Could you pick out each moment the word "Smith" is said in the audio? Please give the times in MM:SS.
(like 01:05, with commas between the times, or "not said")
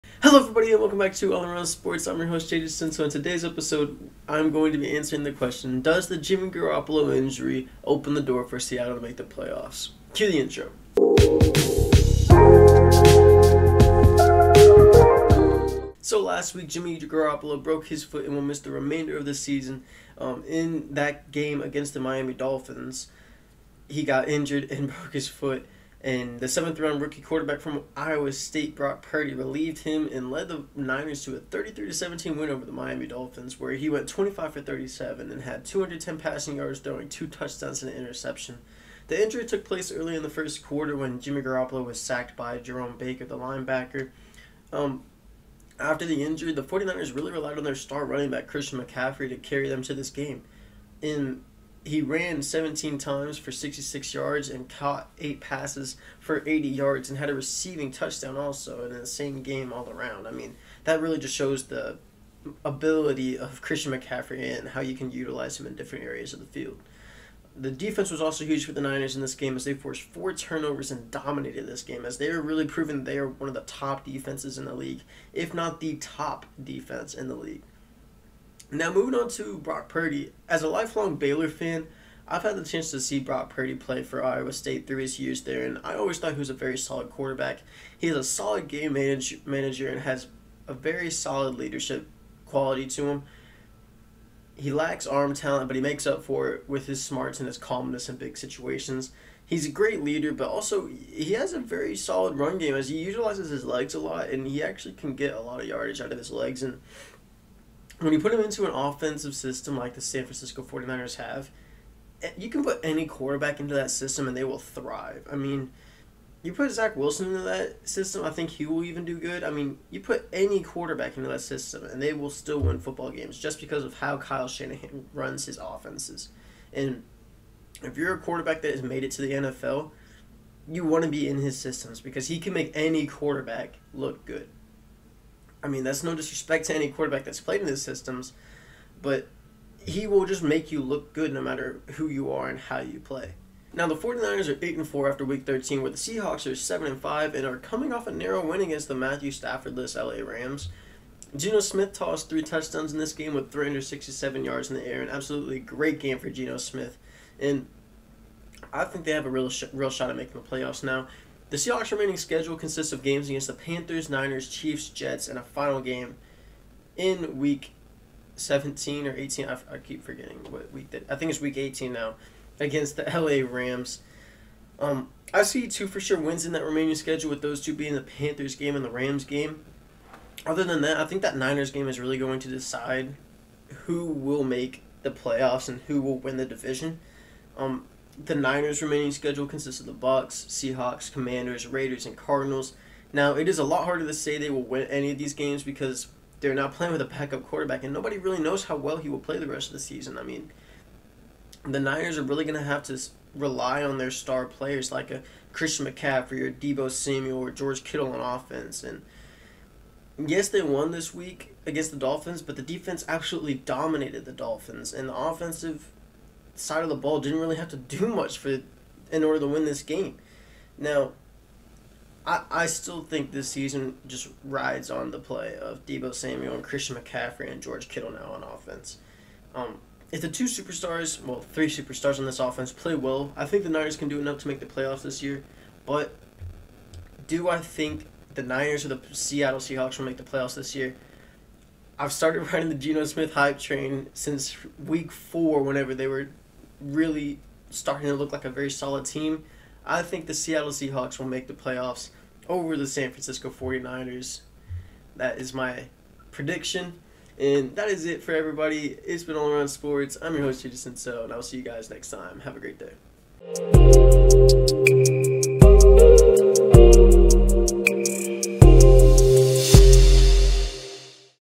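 02:31, 02:36, 04:03.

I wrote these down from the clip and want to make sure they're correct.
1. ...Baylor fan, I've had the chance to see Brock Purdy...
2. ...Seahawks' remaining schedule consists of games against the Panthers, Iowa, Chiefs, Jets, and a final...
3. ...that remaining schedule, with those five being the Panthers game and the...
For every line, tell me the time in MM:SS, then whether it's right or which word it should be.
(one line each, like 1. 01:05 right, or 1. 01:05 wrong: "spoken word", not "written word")
1. 01:21 right
2. 02:41 wrong: "Niners", not "Iowa"
3. 02:56 wrong: "two", not "five".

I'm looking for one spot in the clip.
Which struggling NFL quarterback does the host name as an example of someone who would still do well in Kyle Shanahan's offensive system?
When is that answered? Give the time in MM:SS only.
01:56.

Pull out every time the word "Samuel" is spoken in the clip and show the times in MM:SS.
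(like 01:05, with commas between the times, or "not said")
03:26, 03:46.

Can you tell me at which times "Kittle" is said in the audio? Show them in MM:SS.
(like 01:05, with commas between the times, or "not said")
03:27, 03:47.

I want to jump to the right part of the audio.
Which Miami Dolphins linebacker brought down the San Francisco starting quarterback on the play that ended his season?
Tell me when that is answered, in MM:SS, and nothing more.
00:42.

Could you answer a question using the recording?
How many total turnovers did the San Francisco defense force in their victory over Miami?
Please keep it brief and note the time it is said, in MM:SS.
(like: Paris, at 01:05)
4, at 01:10.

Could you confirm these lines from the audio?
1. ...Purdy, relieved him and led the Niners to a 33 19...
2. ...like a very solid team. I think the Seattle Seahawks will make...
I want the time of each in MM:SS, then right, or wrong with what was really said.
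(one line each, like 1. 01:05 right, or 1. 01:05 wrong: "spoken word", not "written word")
1. 00:29 wrong: "17", not "19"
2. 04:08 right.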